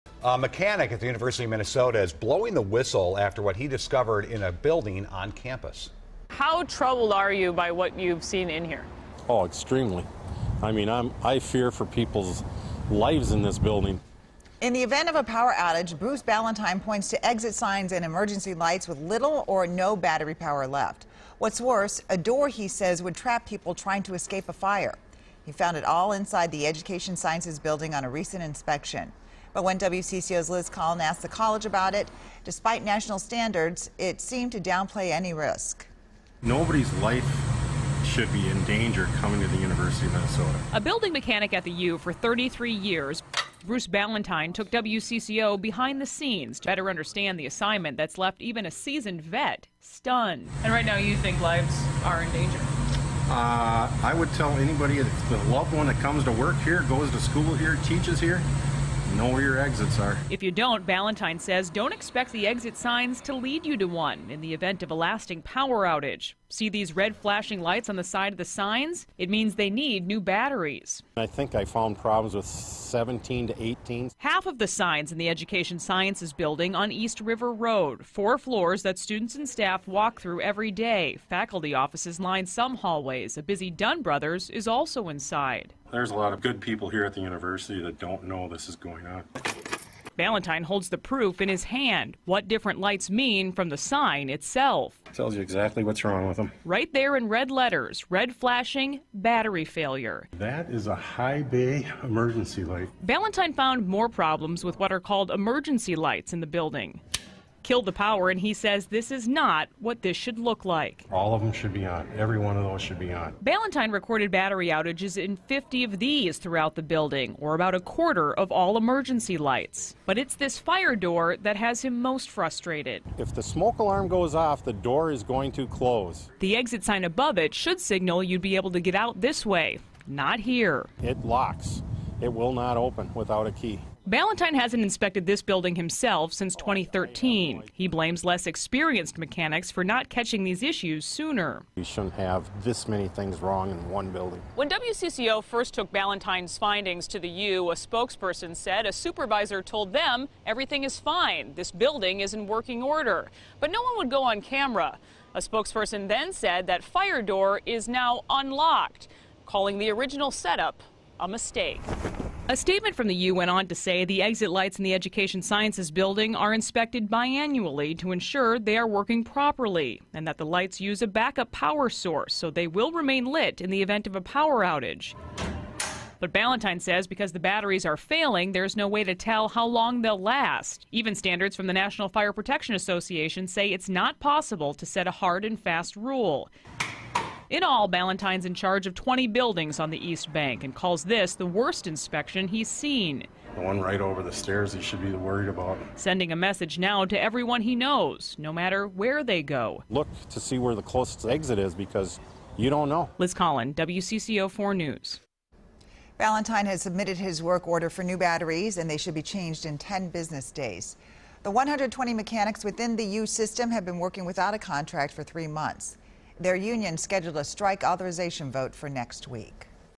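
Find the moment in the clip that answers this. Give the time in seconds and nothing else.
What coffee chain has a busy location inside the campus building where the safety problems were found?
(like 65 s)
83 s.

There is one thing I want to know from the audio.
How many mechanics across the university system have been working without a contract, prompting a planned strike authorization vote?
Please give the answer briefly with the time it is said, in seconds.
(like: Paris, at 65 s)
120, at 211 s.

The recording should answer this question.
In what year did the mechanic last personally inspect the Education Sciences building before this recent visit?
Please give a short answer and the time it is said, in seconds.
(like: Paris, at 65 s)
2013, at 136 s.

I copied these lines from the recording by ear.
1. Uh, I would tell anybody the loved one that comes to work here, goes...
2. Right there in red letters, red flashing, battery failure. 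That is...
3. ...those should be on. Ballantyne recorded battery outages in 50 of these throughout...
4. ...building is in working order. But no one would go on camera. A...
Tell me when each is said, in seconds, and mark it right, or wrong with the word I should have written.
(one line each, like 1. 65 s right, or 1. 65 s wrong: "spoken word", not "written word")
1. 53 s right
2. 96 s right
3. 112 s right
4. 151 s right.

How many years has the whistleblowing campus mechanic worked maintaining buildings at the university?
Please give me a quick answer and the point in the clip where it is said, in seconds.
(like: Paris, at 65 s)
33, at 42 s.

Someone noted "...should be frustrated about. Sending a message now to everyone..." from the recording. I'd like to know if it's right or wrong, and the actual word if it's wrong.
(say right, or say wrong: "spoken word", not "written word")
wrong: "worried", not "frustrated".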